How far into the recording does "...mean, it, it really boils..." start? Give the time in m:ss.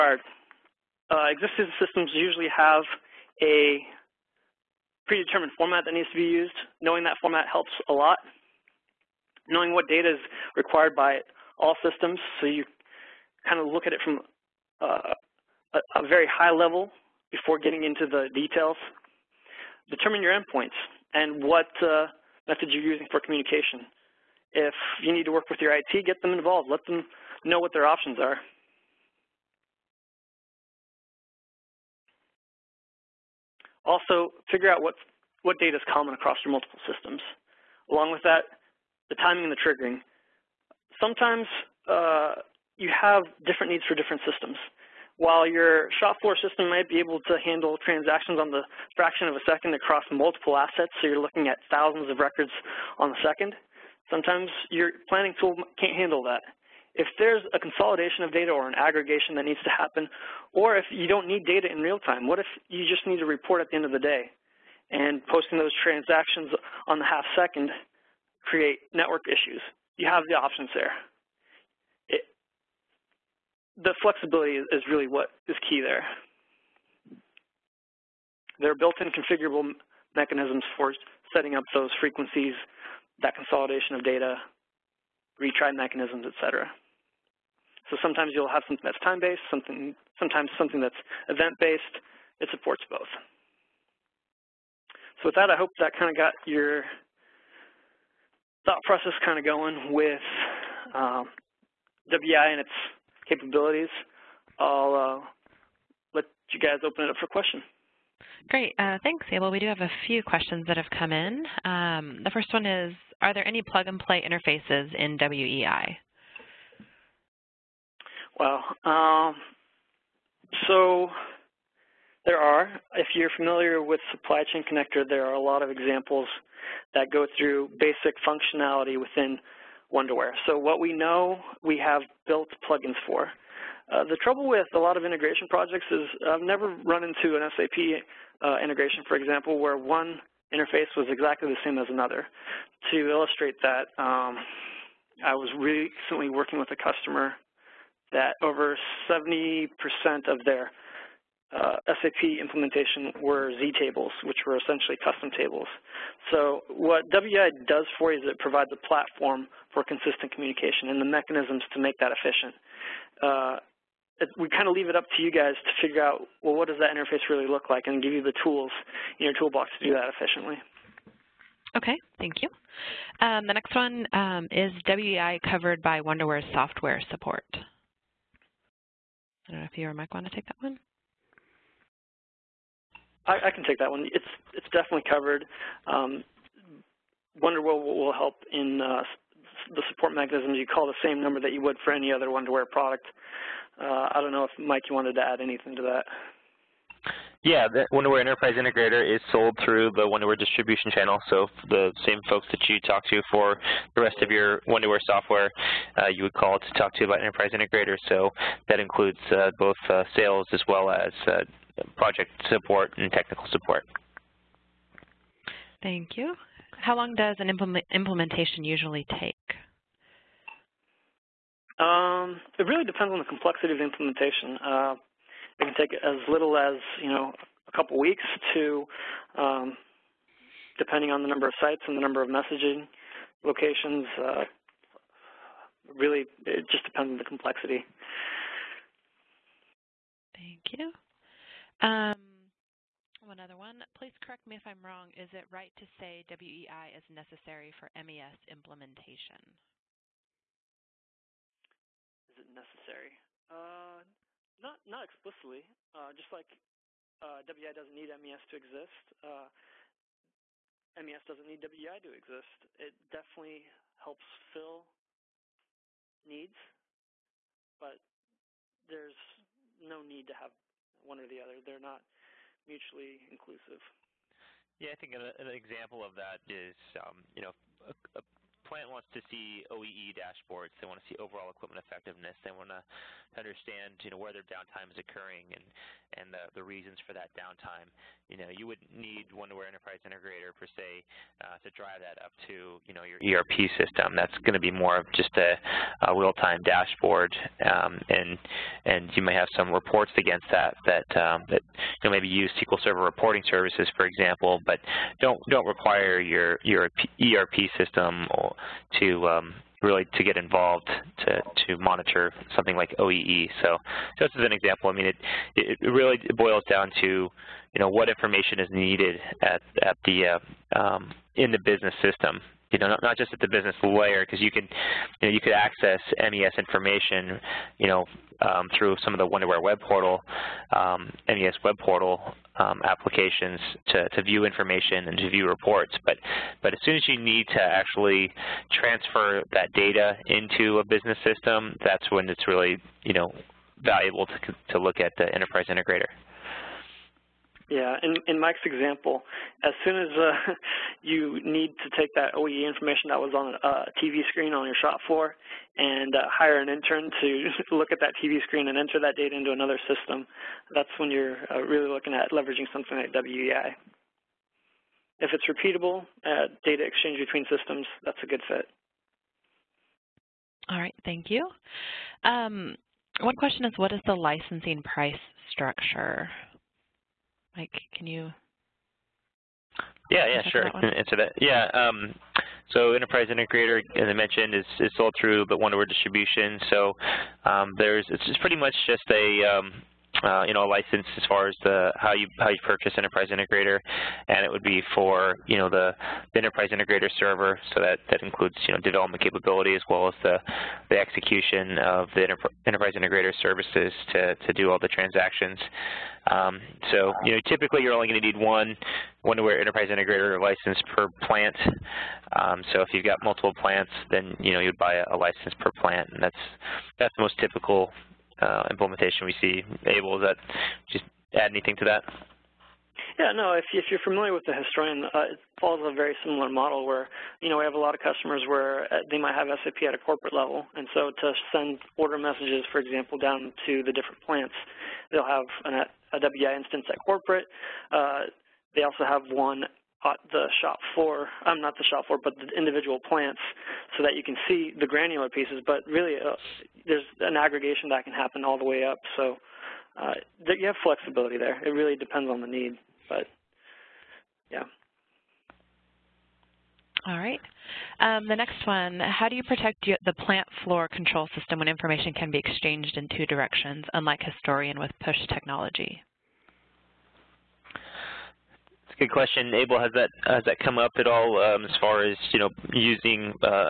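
5:14.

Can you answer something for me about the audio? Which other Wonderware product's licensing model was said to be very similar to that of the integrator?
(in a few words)
the historian.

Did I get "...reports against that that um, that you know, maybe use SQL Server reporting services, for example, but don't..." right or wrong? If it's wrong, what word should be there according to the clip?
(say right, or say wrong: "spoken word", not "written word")
right.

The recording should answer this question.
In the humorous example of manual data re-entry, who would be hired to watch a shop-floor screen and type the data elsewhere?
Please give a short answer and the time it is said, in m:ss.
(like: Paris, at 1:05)
an intern, at 5:56.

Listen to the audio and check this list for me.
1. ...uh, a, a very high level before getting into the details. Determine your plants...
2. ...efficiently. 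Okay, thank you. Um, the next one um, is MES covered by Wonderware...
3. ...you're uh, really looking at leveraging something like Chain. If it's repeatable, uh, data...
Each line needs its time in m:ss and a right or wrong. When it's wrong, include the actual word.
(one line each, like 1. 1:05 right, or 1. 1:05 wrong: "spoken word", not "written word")
1. 0:14 wrong: "endpoints", not "plants"
2. 2:50 wrong: "WEI", not "MES"
3. 6:01 wrong: "WEI", not "Chain".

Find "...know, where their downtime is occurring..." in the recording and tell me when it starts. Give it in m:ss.
4:44.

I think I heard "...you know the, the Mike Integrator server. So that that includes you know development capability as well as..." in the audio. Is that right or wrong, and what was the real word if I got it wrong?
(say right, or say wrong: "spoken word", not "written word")
wrong: "Enterprise", not "Mike".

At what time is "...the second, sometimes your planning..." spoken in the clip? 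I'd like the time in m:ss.
0:53.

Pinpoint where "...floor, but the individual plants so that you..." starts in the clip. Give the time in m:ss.
7:22.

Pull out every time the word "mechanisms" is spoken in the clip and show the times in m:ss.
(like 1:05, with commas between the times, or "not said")
1:20, 1:25, 2:41, 3:10.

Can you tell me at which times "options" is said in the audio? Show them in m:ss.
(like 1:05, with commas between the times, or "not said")
0:27, 1:10.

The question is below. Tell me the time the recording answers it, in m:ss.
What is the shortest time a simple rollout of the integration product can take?
3:47.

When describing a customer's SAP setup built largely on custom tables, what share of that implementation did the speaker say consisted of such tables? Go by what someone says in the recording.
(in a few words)
over 70%.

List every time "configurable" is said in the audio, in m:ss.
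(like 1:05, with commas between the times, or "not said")
1:19.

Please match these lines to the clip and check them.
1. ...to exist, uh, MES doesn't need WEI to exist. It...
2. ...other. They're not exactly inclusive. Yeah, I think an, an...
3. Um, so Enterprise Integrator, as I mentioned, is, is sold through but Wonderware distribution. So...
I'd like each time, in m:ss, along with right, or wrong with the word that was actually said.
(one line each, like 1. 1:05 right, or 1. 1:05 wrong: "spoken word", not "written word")
1. 4:18 right
2. 4:31 wrong: "mutually", not "exactly"
3. 6:21 right.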